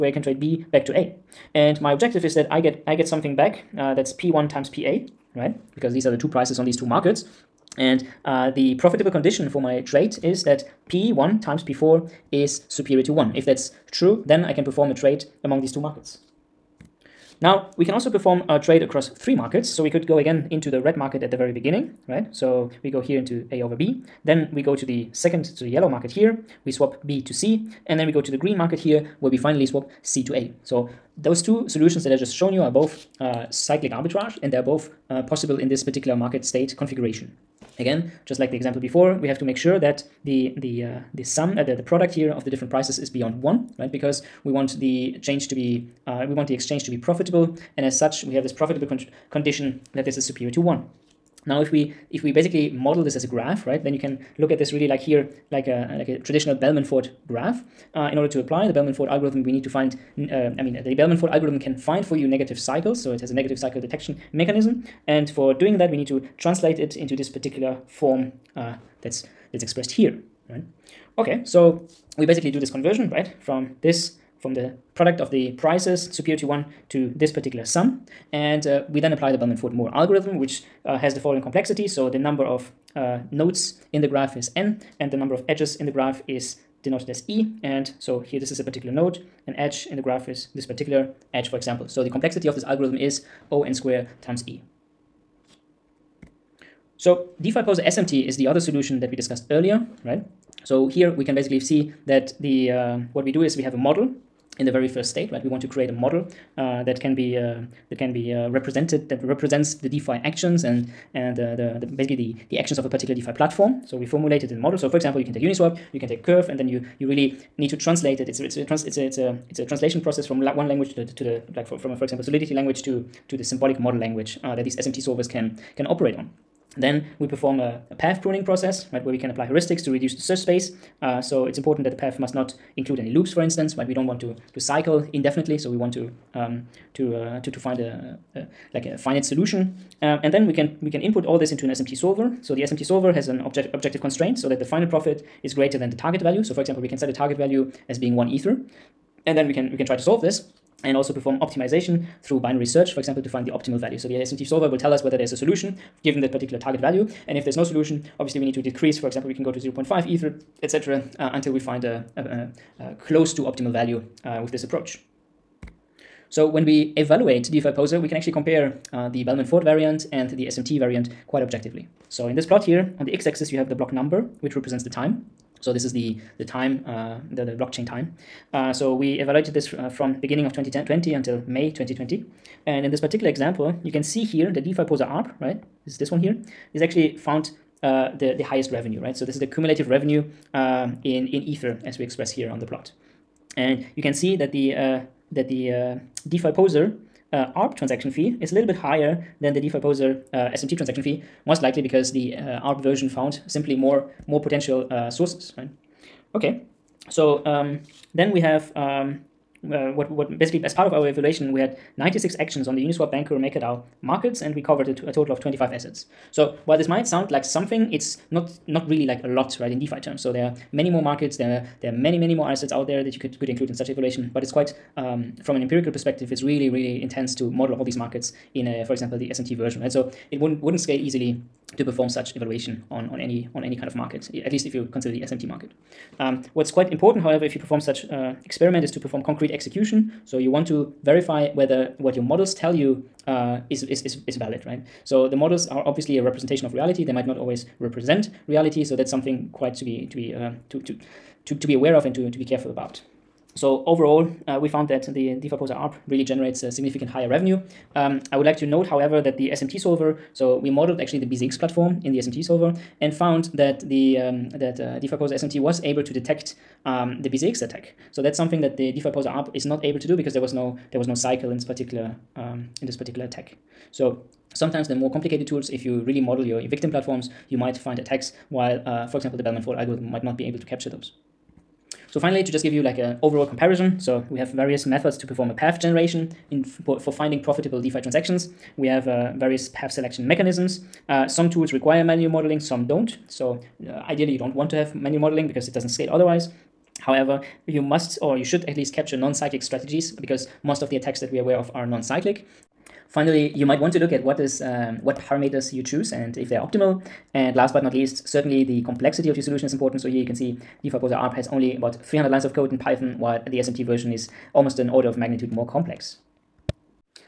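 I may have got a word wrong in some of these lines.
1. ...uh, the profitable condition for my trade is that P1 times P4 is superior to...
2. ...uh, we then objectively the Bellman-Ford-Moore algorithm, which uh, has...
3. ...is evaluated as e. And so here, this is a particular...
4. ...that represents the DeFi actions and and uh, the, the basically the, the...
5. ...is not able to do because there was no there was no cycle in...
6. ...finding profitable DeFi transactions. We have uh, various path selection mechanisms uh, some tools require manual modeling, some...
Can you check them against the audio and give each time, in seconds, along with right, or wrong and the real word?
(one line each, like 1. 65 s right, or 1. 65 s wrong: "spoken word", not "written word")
1. 8 s right
2. 78 s wrong: "apply", not "objectively"
3. 86 s wrong: "denoted", not "evaluated"
4. 109 s right
5. 269 s right
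6. 287 s right.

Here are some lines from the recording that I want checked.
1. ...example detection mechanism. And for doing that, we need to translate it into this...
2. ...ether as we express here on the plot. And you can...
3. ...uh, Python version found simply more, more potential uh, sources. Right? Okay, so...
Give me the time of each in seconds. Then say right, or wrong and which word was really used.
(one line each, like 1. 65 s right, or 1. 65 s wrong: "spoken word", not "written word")
1. 63 s wrong: "cycle", not "example"
2. 191 s right
3. 202 s wrong: "ARB", not "Python".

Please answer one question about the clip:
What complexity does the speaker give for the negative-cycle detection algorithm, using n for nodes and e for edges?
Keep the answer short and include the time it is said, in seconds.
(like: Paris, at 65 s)
O(n² · e), at 93 s.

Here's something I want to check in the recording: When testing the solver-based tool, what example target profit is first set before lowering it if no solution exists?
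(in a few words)
1 ether.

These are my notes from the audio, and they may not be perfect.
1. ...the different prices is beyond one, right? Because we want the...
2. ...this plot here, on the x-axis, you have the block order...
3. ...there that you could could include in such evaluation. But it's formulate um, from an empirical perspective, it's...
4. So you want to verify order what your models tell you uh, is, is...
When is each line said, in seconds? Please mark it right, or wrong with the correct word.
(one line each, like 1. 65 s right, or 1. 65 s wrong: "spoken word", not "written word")
1. 42 s right
2. 172 s wrong: "number", not "order"
3. 222 s wrong: "quite", not "formulate"
4. 240 s wrong: "whether", not "order".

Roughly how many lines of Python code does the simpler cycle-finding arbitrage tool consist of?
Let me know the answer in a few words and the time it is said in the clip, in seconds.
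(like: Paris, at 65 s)
300, at 311 s.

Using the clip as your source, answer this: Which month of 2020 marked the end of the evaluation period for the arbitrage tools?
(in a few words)
May.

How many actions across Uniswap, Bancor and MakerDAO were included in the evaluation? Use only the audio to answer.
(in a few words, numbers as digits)
96.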